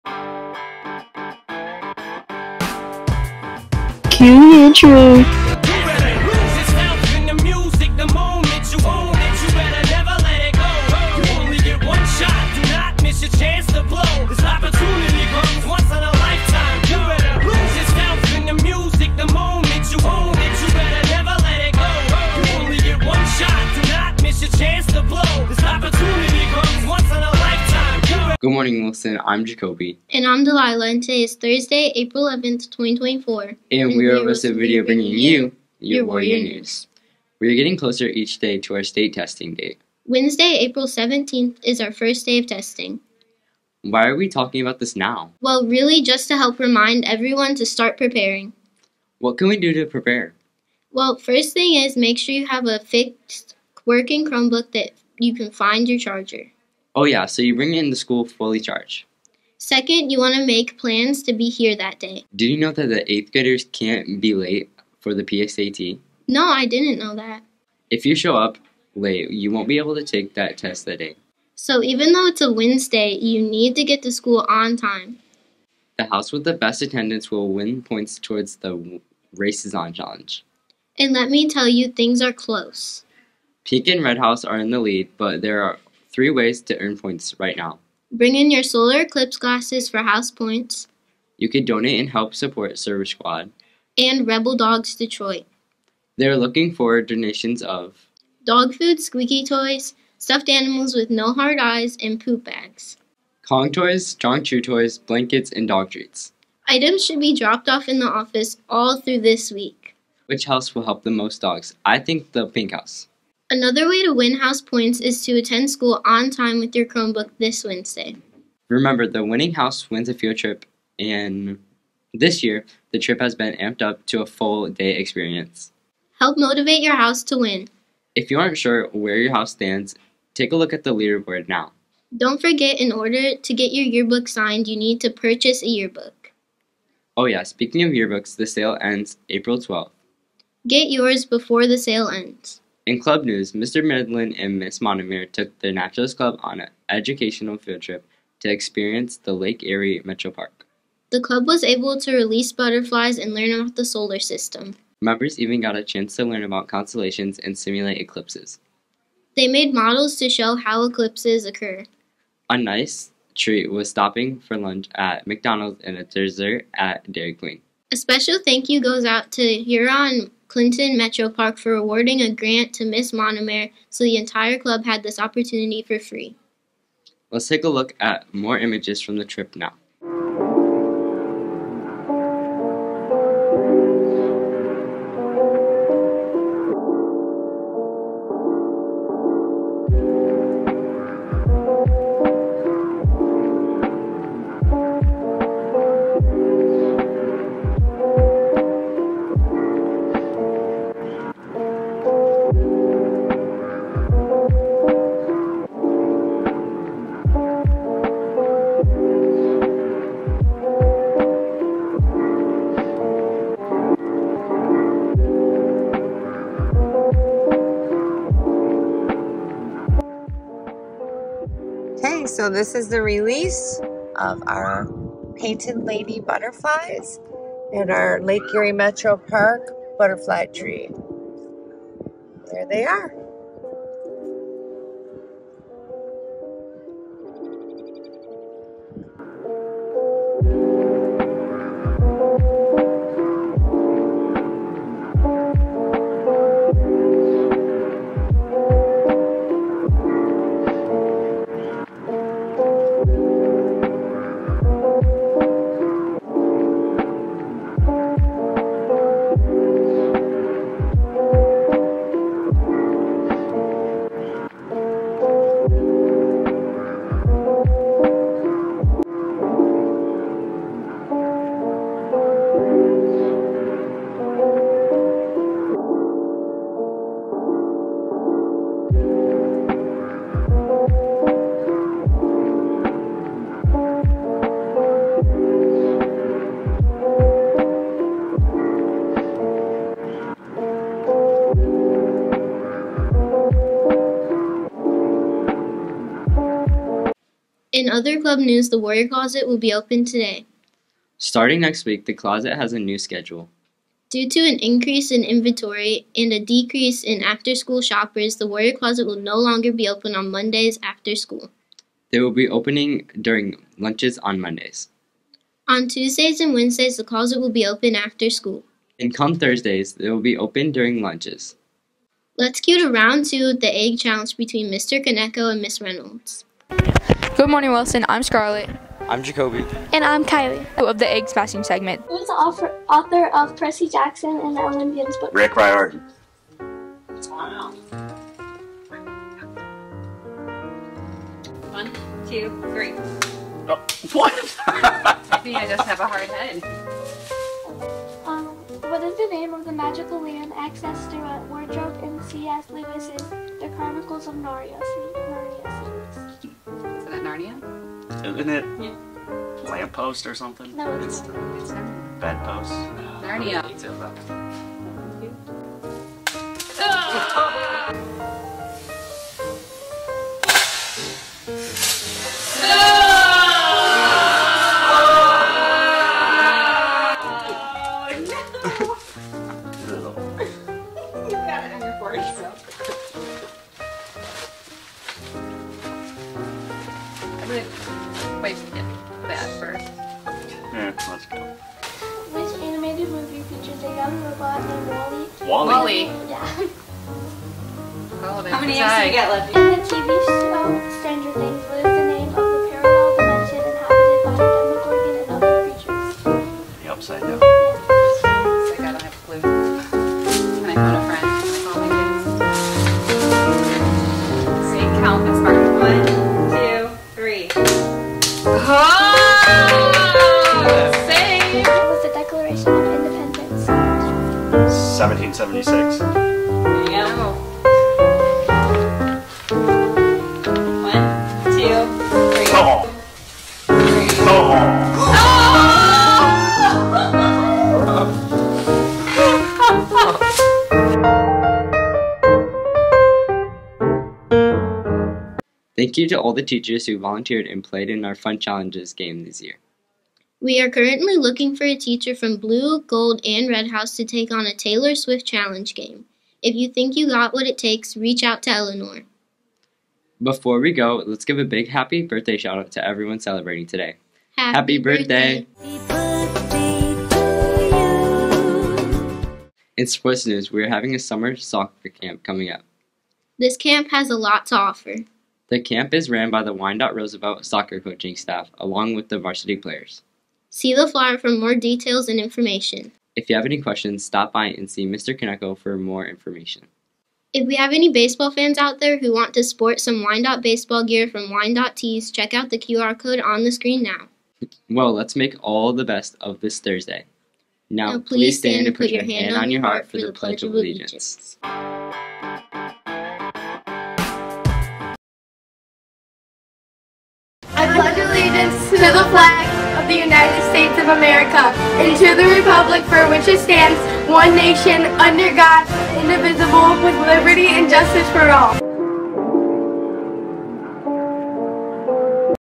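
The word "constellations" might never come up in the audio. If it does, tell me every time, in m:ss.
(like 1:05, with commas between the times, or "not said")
2:36.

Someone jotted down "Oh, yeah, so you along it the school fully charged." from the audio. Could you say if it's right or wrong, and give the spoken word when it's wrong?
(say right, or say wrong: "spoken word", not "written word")
wrong: "bring", not "along".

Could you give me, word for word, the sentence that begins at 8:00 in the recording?
See the flyer for more details and information.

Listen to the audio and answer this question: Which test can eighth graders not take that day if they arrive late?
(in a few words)
PSAT.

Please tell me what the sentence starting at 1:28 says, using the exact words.
Bring in your solar eclipse glasses for house points.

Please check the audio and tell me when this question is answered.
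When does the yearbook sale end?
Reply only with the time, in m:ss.
2:19.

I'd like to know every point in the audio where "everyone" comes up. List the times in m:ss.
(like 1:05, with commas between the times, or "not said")
0:47, 7:42.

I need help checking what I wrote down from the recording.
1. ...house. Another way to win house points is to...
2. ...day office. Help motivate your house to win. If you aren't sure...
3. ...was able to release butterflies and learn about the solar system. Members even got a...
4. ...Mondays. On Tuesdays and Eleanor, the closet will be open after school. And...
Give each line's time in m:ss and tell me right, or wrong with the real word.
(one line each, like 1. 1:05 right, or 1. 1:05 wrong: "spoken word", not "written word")
1. 1:52 right
2. 2:04 wrong: "experience", not "office"
3. 2:31 right
4. 5:14 wrong: "Wednesdays", not "Eleanor".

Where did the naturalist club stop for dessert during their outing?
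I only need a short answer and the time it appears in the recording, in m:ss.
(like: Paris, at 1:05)
Dairy Queen, at 2:47.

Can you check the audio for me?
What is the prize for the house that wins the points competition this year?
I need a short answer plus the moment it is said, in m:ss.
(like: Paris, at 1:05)
A field trip, at 2:00.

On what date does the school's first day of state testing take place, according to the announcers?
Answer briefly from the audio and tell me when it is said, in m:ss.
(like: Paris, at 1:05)
April 17th, at 0:40.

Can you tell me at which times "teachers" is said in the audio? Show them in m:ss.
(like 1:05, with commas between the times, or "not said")
7:26, 7:31.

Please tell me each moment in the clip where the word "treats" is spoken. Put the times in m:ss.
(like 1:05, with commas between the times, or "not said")
1:45, 2:43.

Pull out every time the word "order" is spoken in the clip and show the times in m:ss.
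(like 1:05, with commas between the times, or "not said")
2:12.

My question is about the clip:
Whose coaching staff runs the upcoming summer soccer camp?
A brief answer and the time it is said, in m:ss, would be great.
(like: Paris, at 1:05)
Wyandotte Roosevelt, at 7:56.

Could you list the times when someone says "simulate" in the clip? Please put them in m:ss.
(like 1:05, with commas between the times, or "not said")
2:37.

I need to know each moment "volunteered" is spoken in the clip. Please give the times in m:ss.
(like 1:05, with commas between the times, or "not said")
7:26.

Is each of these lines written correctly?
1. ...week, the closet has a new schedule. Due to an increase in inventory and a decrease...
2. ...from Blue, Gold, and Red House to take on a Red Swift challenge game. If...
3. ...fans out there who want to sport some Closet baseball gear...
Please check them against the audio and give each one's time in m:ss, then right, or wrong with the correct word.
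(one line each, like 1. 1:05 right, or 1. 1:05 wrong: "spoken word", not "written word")
1. 5:01 right
2. 7:32 wrong: "Taylor", not "Red"
3. 8:08 wrong: "Wyandotte", not "Closet".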